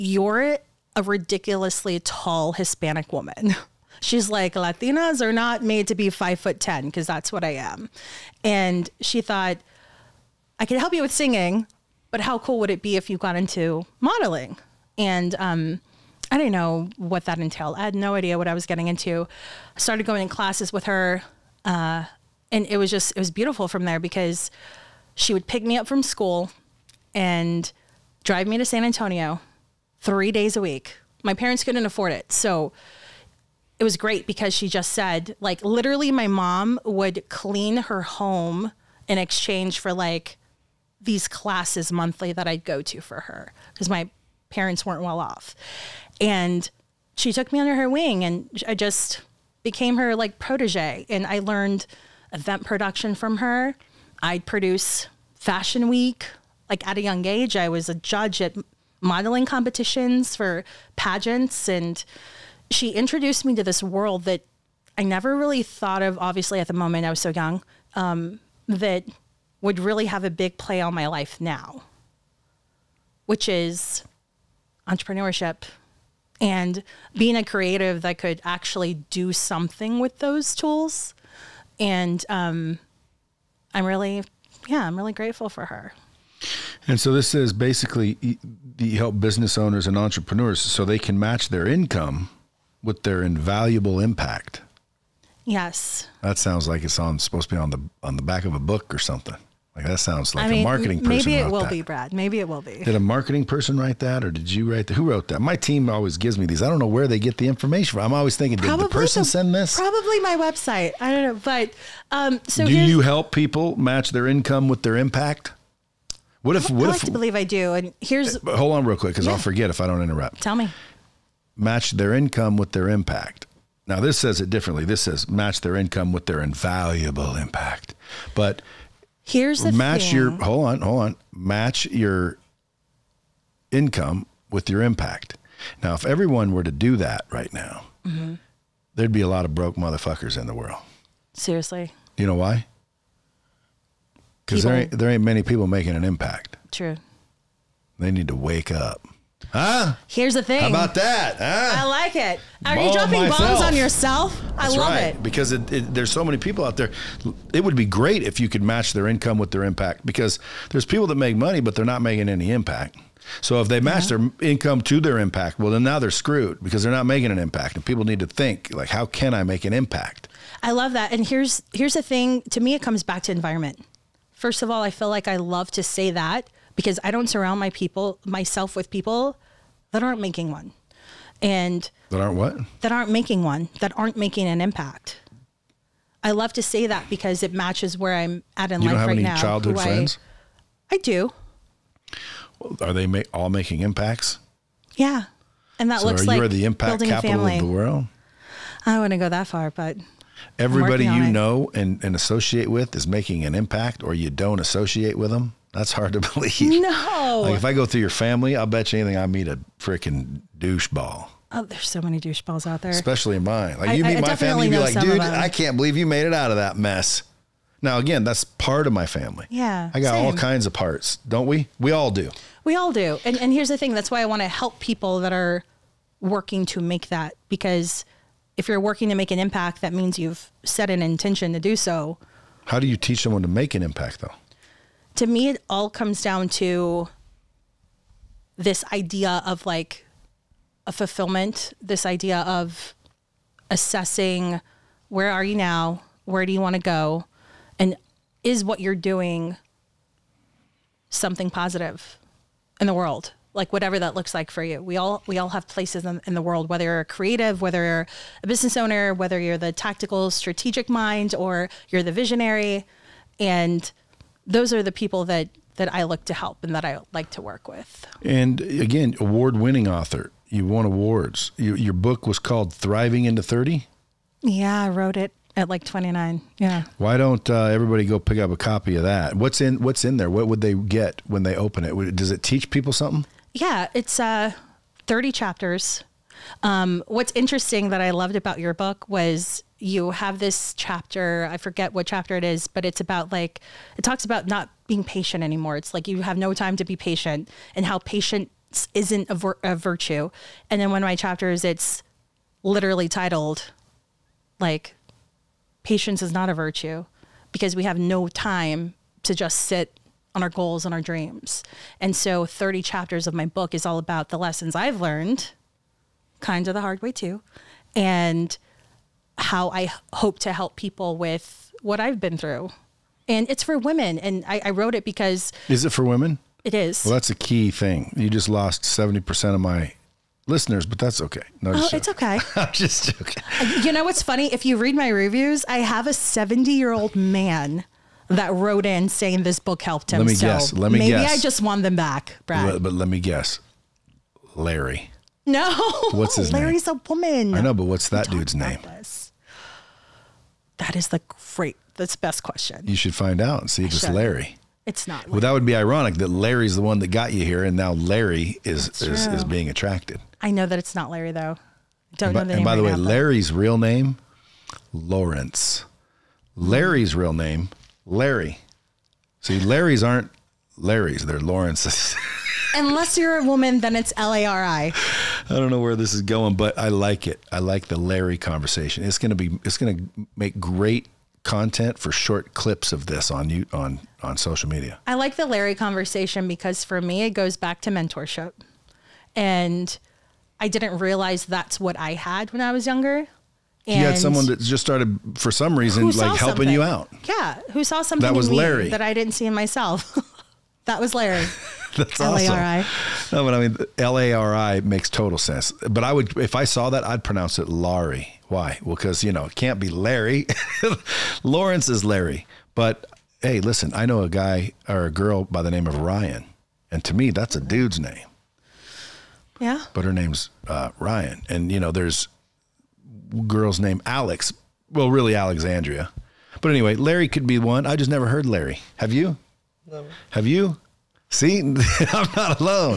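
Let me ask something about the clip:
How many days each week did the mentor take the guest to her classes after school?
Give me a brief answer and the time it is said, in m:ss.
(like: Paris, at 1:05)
3, at 0:30.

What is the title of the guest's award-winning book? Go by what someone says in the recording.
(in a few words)
Thriving into 30.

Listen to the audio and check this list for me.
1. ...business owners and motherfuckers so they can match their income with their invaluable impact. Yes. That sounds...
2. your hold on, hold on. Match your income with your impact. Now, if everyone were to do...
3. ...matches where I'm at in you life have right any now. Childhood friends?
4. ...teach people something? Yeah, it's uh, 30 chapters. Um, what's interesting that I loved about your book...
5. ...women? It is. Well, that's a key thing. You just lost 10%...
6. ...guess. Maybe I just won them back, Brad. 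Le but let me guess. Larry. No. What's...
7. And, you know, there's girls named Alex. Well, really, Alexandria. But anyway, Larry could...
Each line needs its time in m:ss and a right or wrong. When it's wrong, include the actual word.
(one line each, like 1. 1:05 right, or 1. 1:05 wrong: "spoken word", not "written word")
1. 1:29 wrong: "entrepreneurs", not "motherfuckers"
2. 2:10 right
3. 3:07 right
4. 4:42 right
5. 5:26 wrong: "70", not "10"
6. 5:41 right
7. 7:01 right.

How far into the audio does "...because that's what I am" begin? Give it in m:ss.
0:06.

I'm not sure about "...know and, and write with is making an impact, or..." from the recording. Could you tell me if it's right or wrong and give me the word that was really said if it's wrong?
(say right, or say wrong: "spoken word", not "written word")
wrong: "associate", not "write".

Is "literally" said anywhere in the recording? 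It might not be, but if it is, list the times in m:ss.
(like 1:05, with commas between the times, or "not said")
0:35, 5:02.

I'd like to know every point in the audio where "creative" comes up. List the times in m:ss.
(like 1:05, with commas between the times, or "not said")
1:17, 4:17.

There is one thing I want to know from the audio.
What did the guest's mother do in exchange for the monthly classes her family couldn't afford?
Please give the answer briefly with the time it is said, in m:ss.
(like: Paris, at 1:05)
Clean her home, at 0:37.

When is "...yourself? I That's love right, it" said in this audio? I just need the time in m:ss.
2:33.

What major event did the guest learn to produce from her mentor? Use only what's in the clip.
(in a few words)
Fashion Week.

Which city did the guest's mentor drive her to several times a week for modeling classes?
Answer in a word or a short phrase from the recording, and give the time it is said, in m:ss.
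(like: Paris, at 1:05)
San Antonio, at 0:28.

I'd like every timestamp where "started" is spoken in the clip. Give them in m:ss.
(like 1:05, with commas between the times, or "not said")
0:19, 6:34.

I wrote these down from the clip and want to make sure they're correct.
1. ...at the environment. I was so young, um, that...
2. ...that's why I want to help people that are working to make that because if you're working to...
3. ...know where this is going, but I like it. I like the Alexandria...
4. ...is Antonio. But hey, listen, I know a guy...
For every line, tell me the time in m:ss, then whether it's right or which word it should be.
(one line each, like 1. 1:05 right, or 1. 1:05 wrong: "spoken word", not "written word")
1. 1:06 wrong: "moment", not "environment"
2. 3:43 right
3. 6:15 wrong: "Larry", not "Alexandria"
4. 6:51 wrong: "Larry", not "Antonio".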